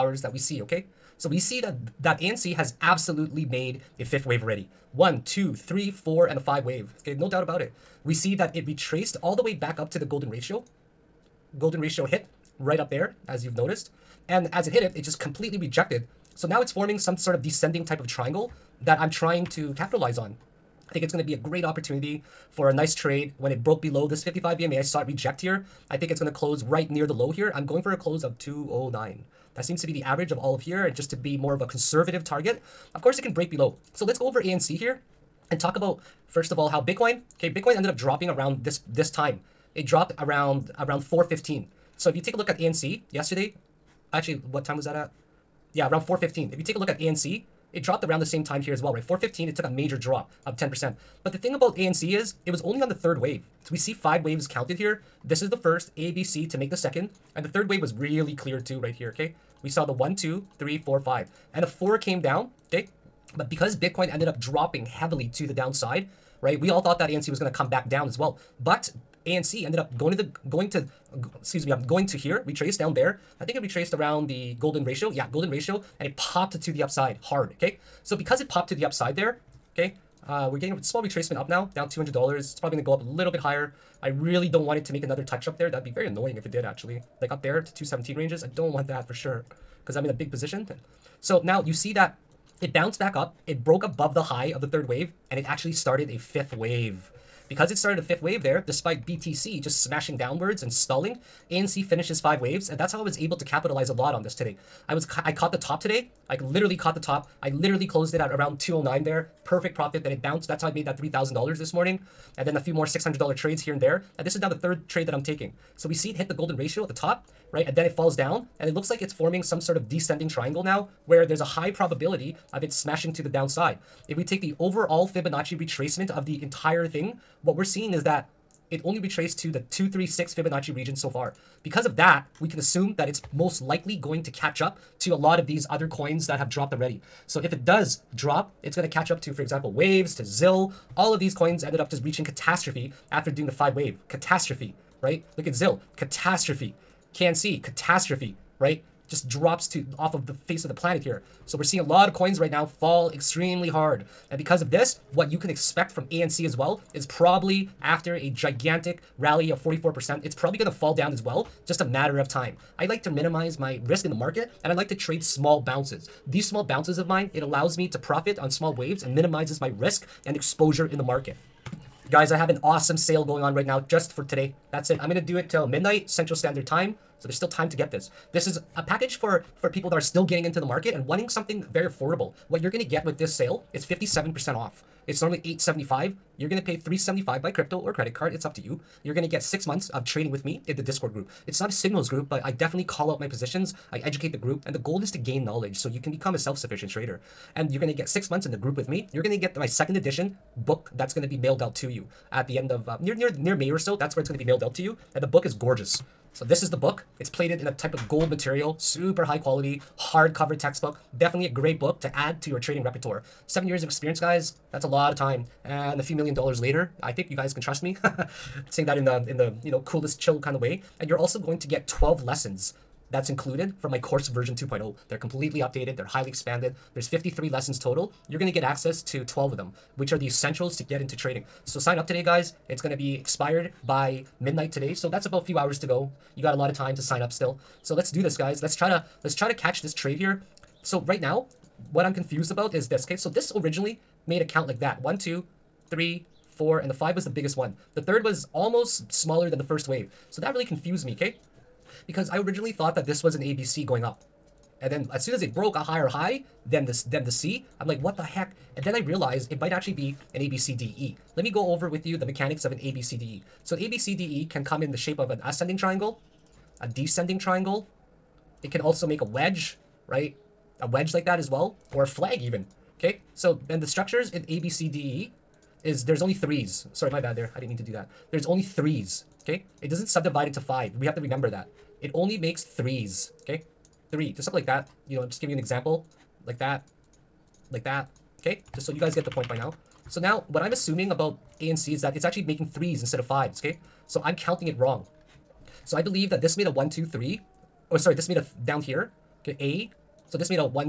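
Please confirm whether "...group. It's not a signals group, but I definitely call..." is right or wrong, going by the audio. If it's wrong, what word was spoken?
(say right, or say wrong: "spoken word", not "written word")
right.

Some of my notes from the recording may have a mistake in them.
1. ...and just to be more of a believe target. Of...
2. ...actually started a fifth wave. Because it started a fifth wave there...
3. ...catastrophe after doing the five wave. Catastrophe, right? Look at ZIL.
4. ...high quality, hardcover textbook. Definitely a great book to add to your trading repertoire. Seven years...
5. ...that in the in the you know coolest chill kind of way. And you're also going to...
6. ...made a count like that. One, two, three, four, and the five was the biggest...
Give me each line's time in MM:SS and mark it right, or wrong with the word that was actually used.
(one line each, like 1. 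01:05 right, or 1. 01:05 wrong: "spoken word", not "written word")
1. 00:30 wrong: "conservative", not "believe"
2. 01:35 right
3. 02:22 right
4. 03:29 right
5. 03:38 right
6. 04:04 right.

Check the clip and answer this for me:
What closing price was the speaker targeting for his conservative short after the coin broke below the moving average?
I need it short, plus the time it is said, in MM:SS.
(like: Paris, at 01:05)
209, at 00:27.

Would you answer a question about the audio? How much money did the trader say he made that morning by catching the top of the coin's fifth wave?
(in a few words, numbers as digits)
$3,000.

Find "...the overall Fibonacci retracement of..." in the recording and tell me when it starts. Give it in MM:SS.
02:04.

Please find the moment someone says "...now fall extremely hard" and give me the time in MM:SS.
02:32.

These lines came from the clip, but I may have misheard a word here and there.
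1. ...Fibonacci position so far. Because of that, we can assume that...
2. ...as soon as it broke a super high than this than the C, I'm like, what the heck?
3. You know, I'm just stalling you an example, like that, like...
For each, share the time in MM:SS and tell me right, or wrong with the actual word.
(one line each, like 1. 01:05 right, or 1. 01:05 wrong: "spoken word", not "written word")
1. 02:10 wrong: "region", not "position"
2. 04:15 wrong: "higher", not "super"
3. 04:45 wrong: "giving", not "stalling".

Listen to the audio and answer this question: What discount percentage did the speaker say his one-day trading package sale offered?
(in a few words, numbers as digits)
57%.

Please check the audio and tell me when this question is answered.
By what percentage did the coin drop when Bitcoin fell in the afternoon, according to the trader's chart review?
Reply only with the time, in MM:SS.
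00:49.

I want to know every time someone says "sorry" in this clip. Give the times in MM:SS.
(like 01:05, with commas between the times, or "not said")
04:36, 04:57.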